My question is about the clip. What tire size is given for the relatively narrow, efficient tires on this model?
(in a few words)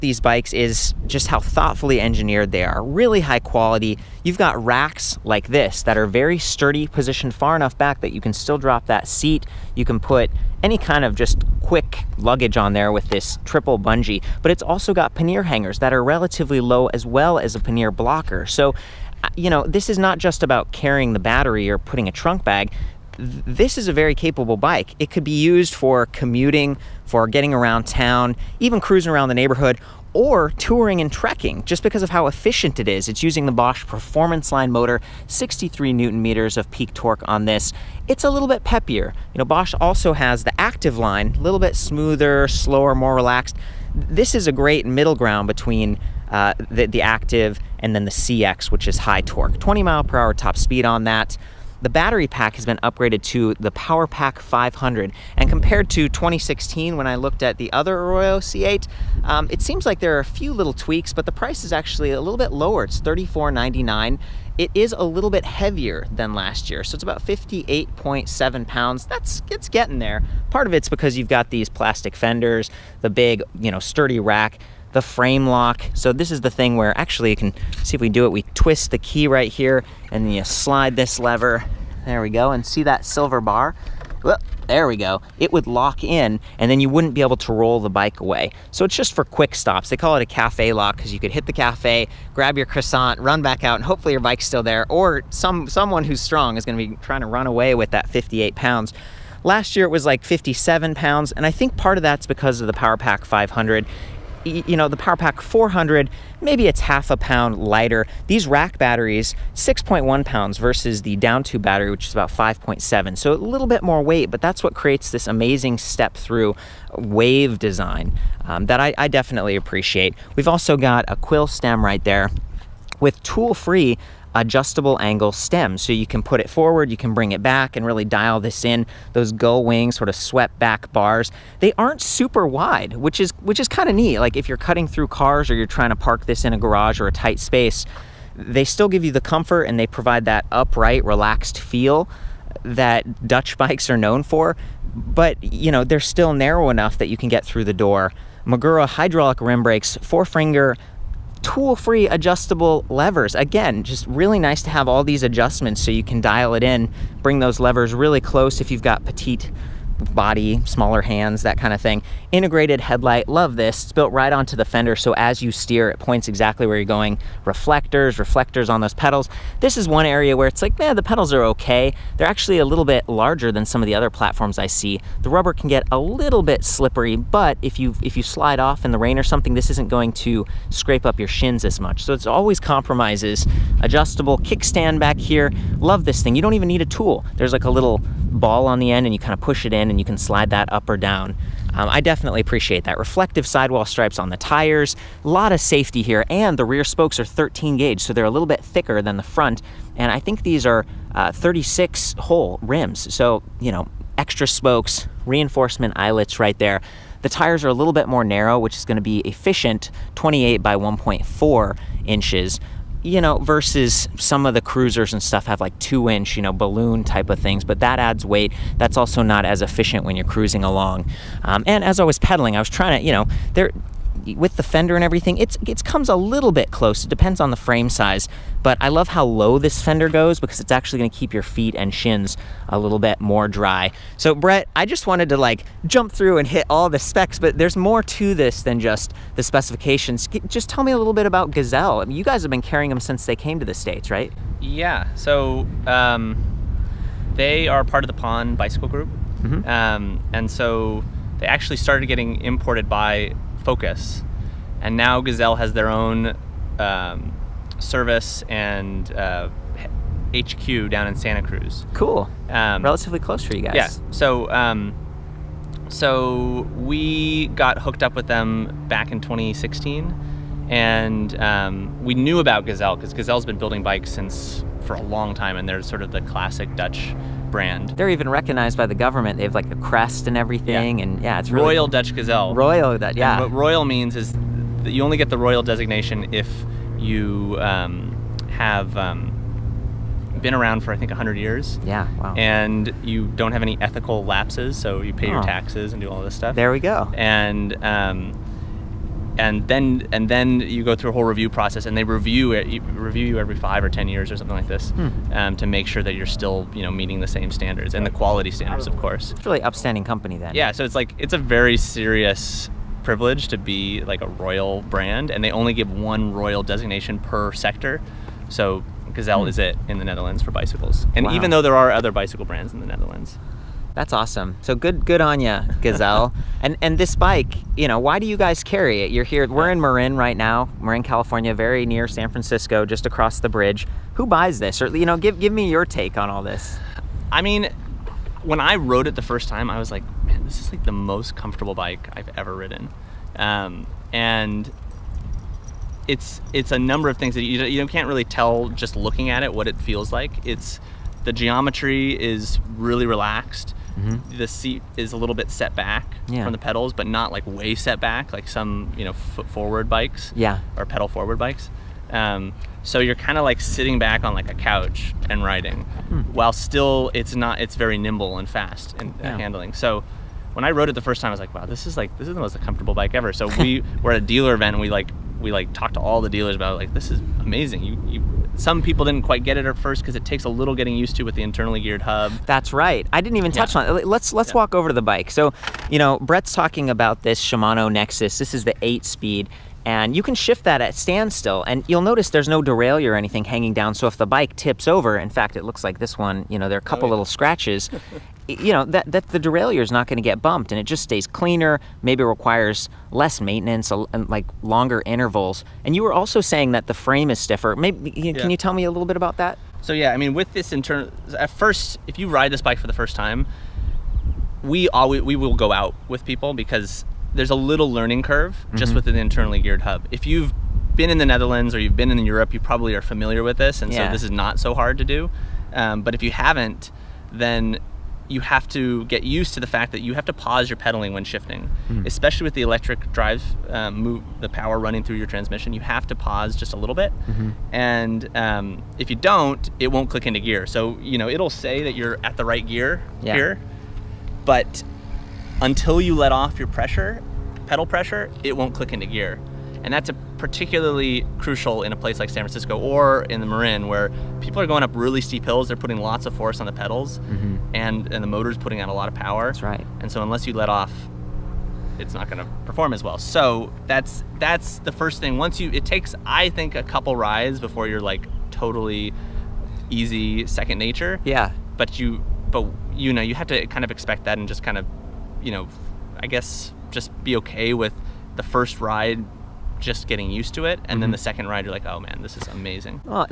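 28 by 1.4 inches.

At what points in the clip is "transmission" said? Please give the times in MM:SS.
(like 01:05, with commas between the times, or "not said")
07:15.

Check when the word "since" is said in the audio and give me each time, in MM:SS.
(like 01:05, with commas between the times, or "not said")
04:02, 04:34.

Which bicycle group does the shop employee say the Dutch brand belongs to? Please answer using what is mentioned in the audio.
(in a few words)
Pon Bicycle Group.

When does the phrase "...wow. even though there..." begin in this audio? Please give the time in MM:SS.
05:21.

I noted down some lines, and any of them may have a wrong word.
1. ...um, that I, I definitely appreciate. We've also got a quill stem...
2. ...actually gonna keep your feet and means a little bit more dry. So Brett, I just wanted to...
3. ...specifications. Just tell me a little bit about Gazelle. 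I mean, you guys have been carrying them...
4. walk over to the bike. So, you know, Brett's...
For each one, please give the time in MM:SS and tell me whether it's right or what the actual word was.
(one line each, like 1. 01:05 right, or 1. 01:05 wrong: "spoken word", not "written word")
1. 01:58 right
2. 03:50 wrong: "shins", not "means"
3. 03:59 right
4. 06:24 right.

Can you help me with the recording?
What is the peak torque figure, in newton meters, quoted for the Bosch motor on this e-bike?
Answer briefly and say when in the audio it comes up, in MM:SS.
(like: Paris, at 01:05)
63, at 00:35.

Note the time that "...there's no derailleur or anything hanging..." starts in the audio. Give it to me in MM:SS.
06:32.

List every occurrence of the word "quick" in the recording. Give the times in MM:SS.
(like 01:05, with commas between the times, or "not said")
00:11, 01:29.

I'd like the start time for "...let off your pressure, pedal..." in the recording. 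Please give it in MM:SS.
07:26.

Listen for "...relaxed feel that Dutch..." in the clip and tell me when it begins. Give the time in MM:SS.
02:21.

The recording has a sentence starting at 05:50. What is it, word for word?
It's the geometry is really relaxed mm -hmm.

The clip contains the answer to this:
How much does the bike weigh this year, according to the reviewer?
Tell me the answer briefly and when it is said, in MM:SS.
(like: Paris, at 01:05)
58.7 pounds, at 01:07.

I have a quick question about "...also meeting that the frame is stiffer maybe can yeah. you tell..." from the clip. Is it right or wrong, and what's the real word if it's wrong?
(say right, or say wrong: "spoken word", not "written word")
wrong: "saying", not "meeting".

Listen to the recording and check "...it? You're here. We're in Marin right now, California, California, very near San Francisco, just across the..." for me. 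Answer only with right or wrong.
wrong.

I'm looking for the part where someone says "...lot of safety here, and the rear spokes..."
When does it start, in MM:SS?
03:15.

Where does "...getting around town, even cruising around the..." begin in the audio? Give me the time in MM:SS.
00:27.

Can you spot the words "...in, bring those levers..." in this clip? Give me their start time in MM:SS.
02:36.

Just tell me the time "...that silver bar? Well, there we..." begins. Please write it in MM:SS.
01:22.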